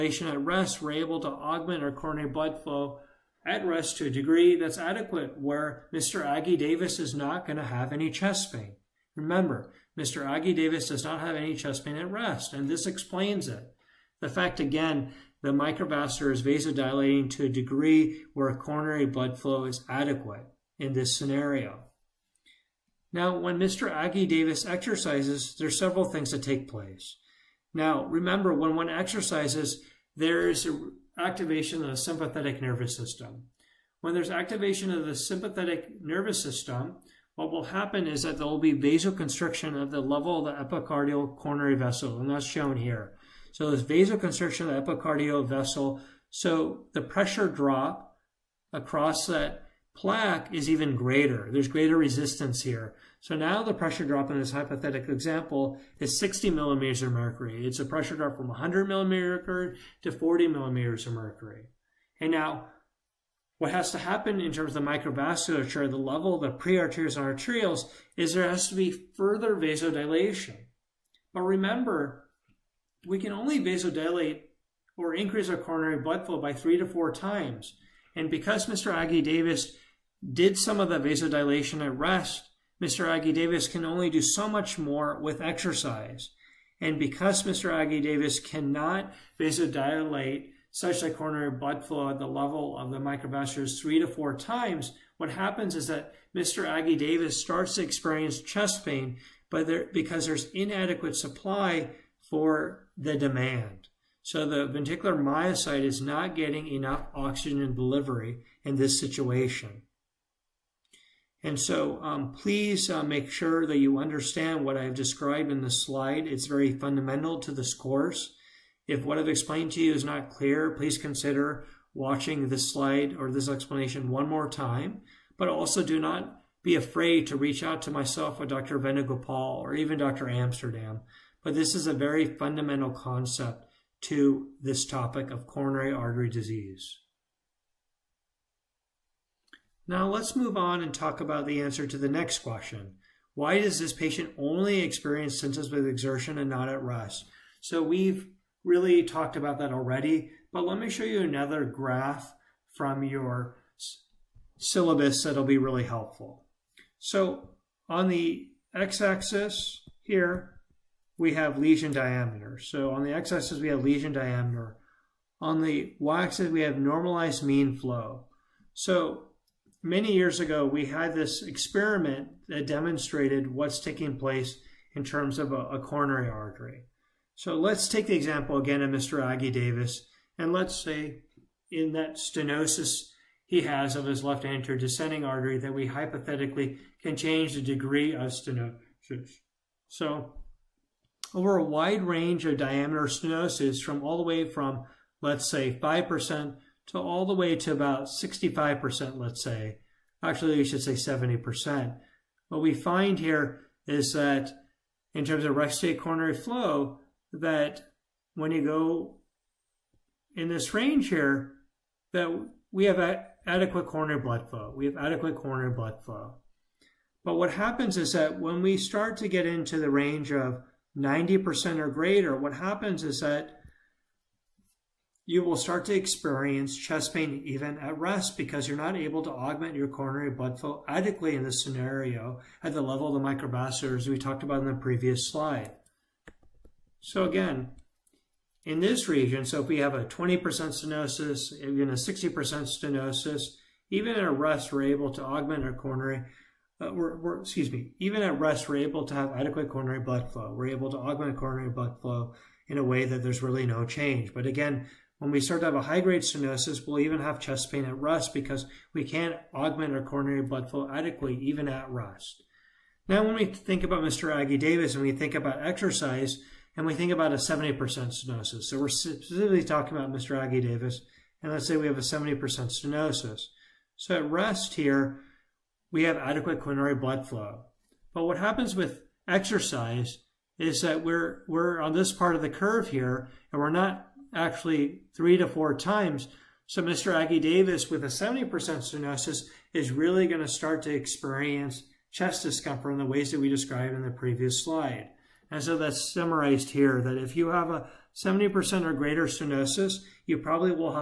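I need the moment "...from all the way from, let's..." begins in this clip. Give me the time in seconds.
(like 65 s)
193 s.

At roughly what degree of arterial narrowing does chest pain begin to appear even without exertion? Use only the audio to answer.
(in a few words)
90% or greater.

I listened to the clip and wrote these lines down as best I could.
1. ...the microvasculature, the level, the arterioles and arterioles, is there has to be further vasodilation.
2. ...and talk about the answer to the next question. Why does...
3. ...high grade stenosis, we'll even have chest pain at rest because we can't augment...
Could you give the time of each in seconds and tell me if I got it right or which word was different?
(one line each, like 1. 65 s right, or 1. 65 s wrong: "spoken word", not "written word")
1. 64 s wrong: "prearterioles", not "arterioles"
2. 140 s right
3. 255 s right.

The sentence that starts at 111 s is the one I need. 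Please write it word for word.
And so um, please uh, make sure that you understand what I've described in this slide.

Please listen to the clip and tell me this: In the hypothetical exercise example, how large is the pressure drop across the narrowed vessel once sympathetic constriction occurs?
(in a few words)
60 mmHg.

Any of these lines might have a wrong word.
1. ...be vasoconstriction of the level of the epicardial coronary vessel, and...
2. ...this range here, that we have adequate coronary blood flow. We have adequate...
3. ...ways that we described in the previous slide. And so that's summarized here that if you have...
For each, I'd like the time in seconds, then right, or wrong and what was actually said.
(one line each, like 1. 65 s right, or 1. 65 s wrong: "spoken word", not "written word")
1. 38 s right
2. 210 s right
3. 293 s right.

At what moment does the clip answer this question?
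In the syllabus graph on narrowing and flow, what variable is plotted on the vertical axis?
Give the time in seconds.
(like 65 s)
166 s.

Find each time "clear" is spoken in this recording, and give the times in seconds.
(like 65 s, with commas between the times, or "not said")
120 s.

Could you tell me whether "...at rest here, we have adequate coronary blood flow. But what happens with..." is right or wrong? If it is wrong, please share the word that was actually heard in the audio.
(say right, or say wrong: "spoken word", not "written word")
right.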